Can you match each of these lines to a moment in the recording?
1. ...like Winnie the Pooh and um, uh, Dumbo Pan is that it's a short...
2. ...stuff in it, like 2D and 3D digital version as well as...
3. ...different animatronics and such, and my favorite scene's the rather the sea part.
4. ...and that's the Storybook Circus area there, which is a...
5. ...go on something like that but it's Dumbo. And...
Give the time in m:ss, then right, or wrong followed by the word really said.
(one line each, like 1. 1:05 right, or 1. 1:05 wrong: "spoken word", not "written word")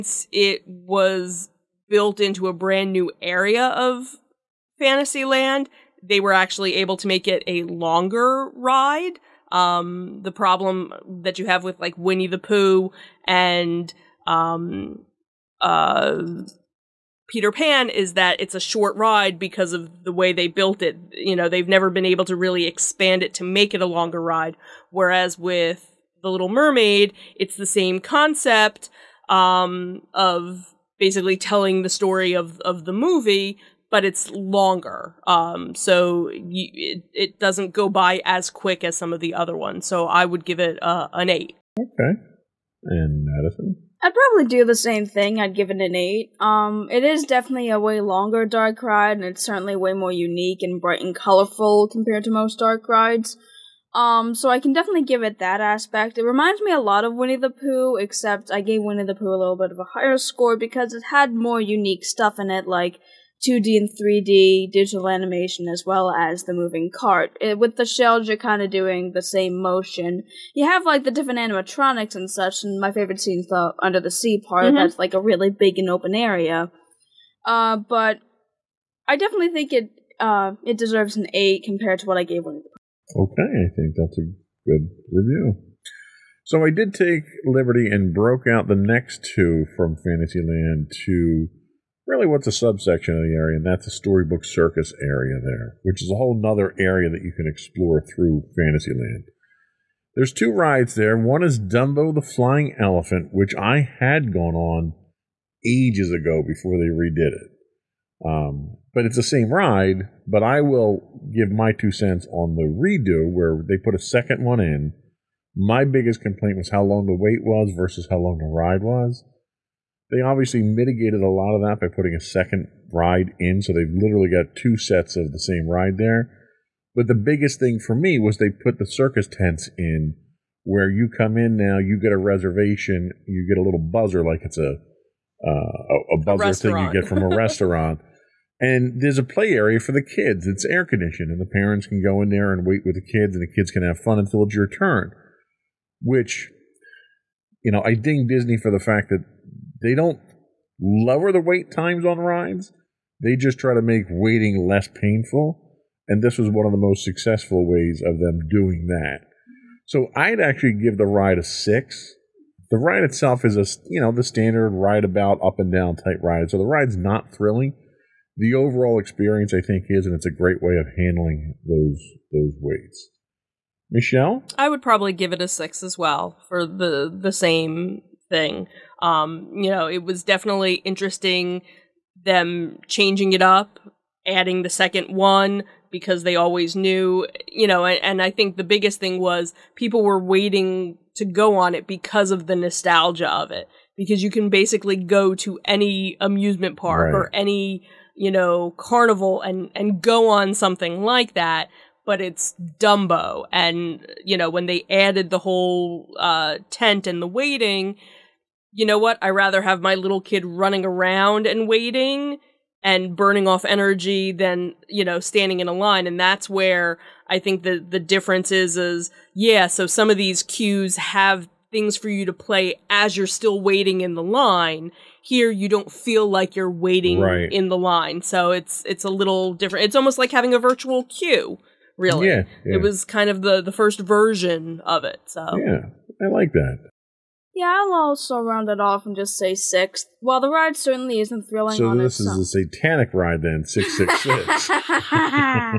1. 0:11 wrong: "Peter", not "Dumbo"
2. 1:02 wrong: "animation", not "version"
3. 1:11 wrong: "under", not "rather"
4. 1:33 right
5. 3:20 right.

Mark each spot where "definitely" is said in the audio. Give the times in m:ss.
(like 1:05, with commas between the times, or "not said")
0:47, 0:54, 1:19, 3:00.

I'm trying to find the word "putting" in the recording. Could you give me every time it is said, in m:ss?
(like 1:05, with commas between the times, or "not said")
2:01.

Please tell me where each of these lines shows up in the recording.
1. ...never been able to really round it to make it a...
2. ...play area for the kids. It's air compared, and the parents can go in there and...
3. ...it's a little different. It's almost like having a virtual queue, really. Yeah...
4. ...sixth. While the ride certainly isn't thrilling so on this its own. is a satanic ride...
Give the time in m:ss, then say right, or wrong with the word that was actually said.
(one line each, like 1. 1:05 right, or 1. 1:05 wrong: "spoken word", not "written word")
1. 0:21 wrong: "expand", not "round"
2. 2:19 wrong: "conditioned", not "compared"
3. 3:48 right
4. 3:59 right.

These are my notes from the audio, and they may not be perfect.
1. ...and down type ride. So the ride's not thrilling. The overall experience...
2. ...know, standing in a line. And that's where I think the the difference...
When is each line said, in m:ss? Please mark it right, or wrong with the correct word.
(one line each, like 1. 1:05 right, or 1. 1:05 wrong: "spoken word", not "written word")
1. 2:45 right
2. 3:35 right.